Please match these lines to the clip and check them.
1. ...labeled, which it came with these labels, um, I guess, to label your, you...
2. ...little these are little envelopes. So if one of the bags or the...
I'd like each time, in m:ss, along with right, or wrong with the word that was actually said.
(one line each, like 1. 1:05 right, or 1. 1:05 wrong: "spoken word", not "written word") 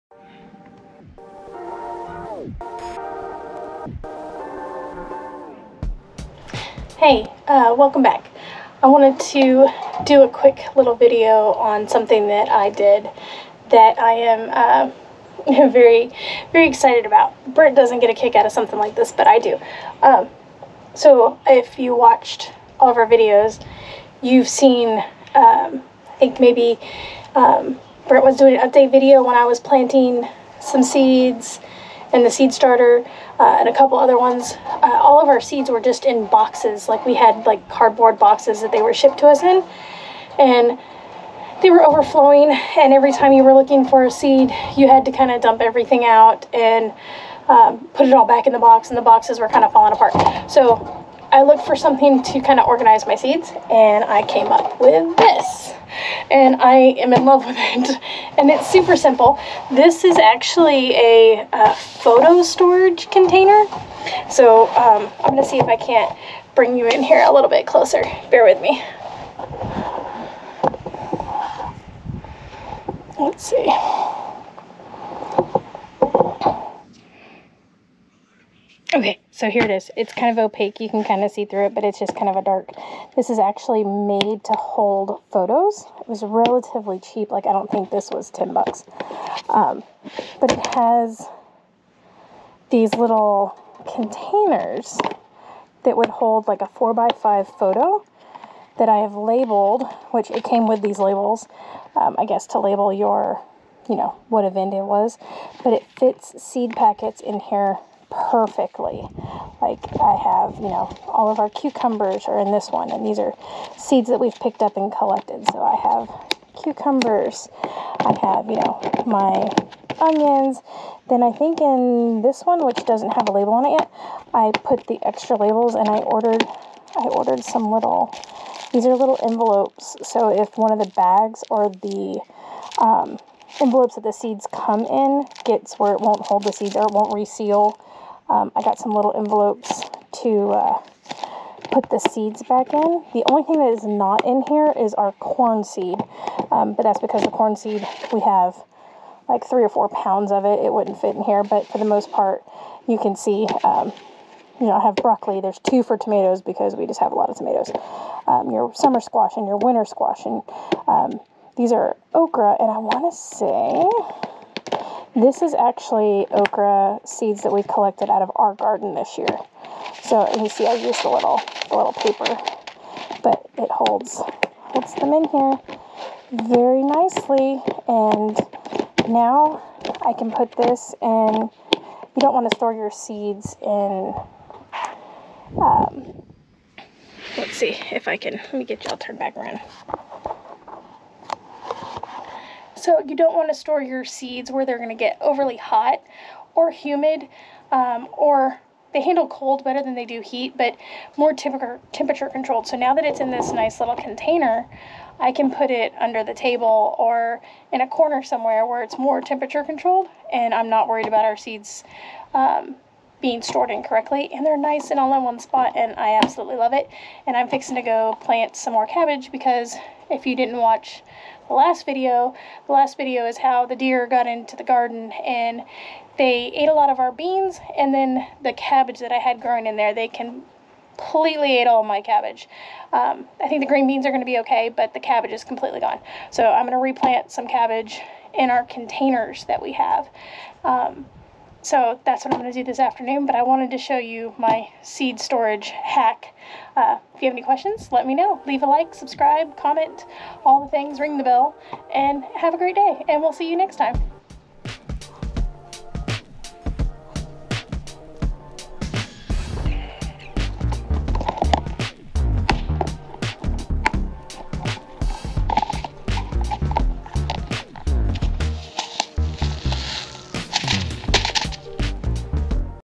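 1. 1:39 right
2. 2:07 right.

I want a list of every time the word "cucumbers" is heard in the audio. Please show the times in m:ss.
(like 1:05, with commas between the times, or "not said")
1:51, 1:56.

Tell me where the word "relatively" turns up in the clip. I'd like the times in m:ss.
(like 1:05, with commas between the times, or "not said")
1:26.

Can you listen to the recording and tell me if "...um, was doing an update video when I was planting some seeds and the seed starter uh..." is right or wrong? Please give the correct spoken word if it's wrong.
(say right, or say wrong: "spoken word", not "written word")
right.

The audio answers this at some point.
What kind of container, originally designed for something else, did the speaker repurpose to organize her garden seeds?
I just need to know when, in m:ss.
1:01.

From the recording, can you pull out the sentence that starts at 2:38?
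Um, your summer squash and your winter squash, and um, these are okra.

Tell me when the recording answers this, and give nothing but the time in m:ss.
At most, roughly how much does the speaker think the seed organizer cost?
1:28.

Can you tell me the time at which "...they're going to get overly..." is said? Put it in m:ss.
3:14.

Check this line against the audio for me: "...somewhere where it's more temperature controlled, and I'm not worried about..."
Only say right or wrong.
right.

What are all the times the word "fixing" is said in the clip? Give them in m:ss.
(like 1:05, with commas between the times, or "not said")
3:37.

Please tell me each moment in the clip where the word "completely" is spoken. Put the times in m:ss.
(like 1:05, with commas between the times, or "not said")
3:50, 3:55.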